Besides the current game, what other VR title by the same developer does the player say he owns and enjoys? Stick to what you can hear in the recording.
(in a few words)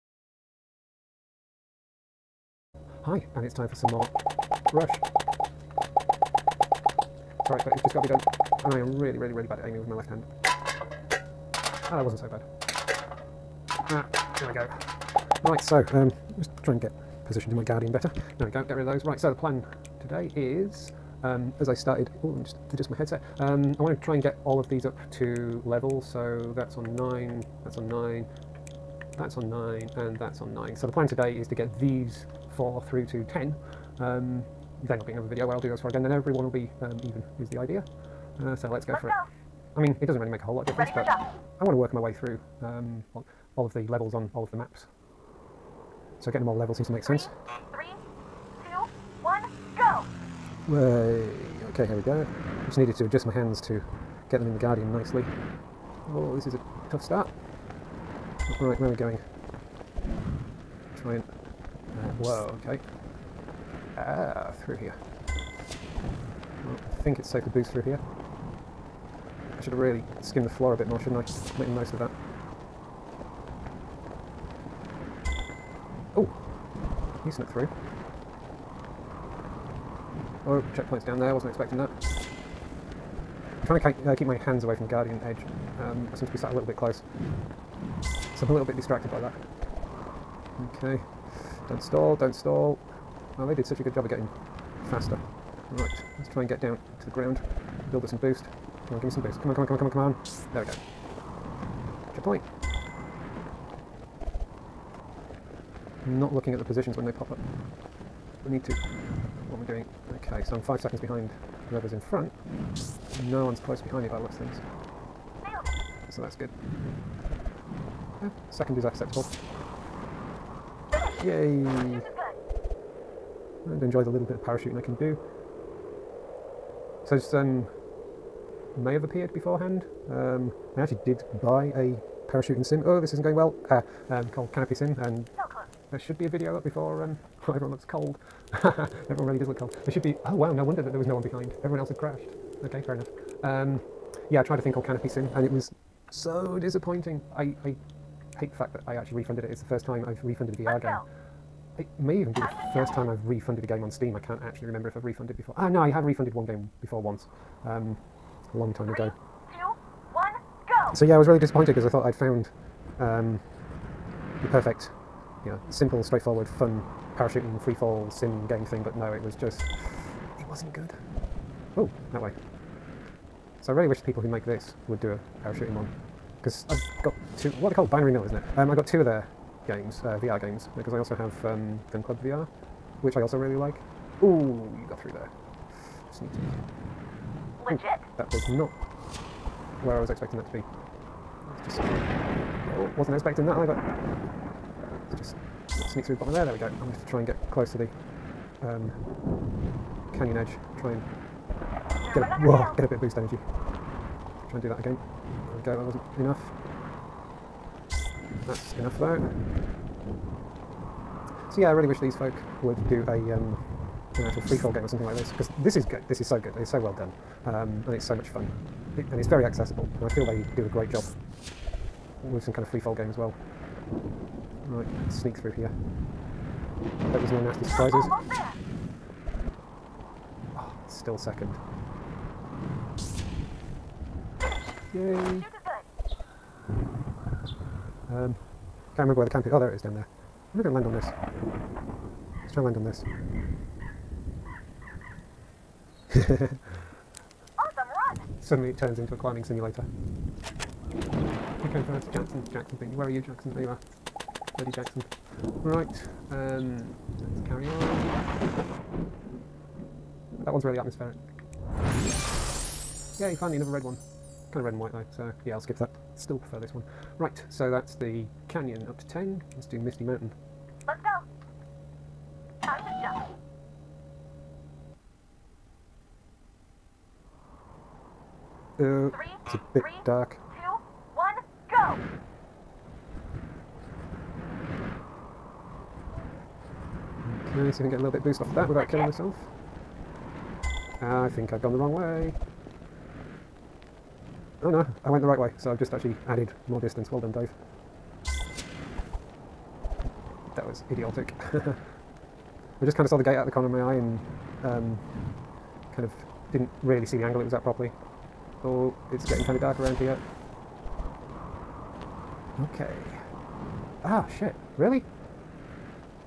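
Gun Club VR.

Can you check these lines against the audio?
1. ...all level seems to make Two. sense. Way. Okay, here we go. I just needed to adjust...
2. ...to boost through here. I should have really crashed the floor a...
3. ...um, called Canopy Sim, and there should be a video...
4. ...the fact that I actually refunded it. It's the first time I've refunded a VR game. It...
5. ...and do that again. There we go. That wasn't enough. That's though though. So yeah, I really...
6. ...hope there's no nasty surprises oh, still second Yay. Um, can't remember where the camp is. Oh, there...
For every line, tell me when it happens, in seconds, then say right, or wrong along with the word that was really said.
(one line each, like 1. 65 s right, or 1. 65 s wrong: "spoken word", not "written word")
1. 46 s wrong: "Three", not "Two"
2. 67 s wrong: "skimmed", not "crashed"
3. 134 s right
4. 148 s right
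5. 204 s wrong: "enough", not "though"
6. 227 s right.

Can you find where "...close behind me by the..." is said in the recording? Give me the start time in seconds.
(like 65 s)
113 s.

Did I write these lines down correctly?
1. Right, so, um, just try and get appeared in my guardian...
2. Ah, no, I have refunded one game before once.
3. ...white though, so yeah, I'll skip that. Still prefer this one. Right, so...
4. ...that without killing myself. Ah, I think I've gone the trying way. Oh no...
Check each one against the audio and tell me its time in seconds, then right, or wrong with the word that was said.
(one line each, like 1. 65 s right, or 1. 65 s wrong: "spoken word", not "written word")
1. 15 s wrong: "positioned", not "appeared"
2. 155 s right
3. 264 s right
4. 288 s wrong: "wrong", not "trying".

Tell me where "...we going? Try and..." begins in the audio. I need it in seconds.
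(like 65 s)
58 s.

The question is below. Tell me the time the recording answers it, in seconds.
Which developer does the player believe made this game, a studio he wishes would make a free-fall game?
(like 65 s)
177 s.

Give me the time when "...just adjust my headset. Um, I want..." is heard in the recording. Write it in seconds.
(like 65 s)
22 s.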